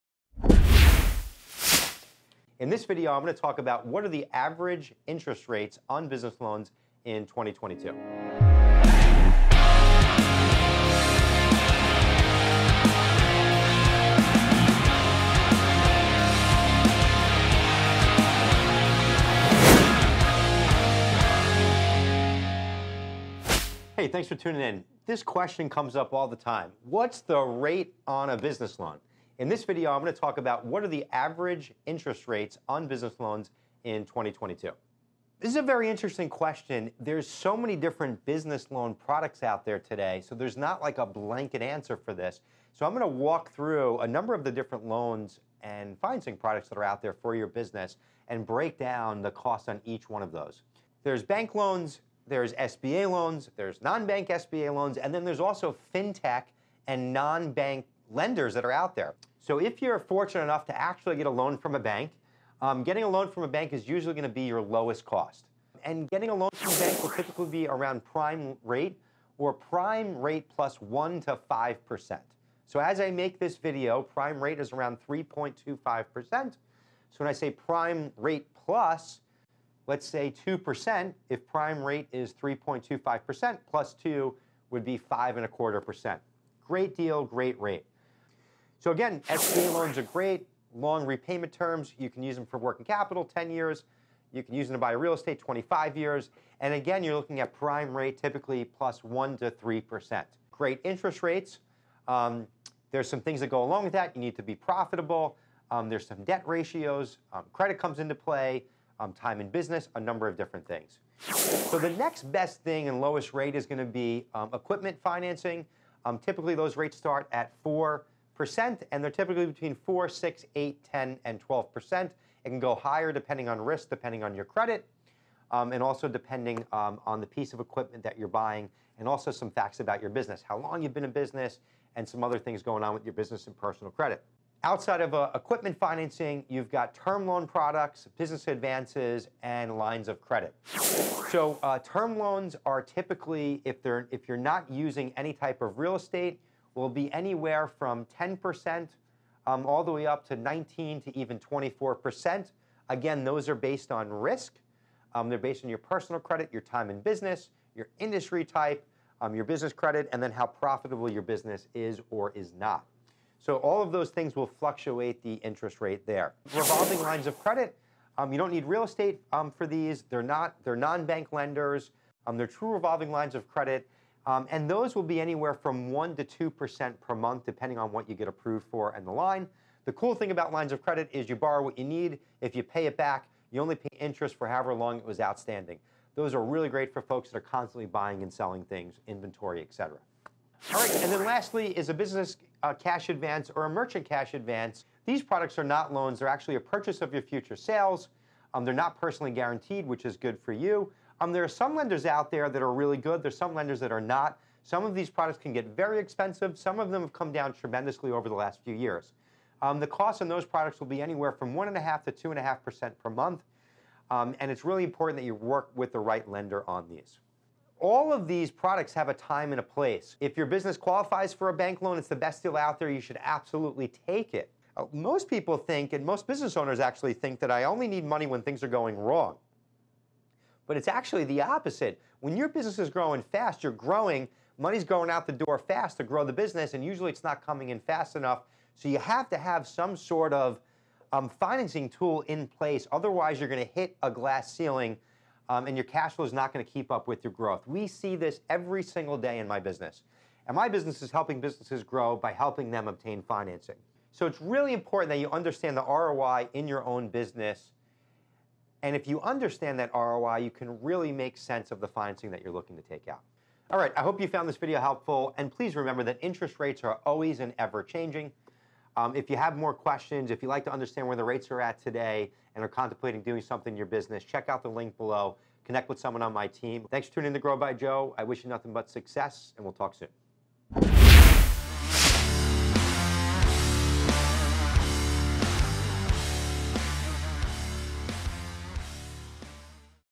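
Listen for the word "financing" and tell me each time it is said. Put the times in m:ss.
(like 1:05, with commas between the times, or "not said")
0:45, 1:55, 2:15, 4:01, 4:13, 4:21.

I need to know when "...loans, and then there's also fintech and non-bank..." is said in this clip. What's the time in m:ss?
0:54.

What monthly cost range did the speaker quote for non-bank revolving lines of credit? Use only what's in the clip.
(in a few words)
1% to 2% per month.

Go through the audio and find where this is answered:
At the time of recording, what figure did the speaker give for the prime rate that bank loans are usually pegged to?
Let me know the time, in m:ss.
1:14.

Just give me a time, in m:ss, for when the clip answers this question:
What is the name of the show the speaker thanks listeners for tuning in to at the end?
4:37.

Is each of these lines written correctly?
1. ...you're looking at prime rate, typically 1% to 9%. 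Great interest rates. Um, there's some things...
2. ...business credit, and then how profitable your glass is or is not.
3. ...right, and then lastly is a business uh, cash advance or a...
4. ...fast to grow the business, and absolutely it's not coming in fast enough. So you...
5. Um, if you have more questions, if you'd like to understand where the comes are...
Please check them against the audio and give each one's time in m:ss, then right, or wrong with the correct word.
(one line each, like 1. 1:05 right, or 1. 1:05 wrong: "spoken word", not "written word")
1. 1:37 wrong: "3", not "9"
2. 2:39 wrong: "business", not "glass"
3. 3:10 right
4. 3:55 wrong: "usually", not "absolutely"
5. 4:28 wrong: "rates", not "comes".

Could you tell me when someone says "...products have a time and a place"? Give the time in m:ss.
3:38.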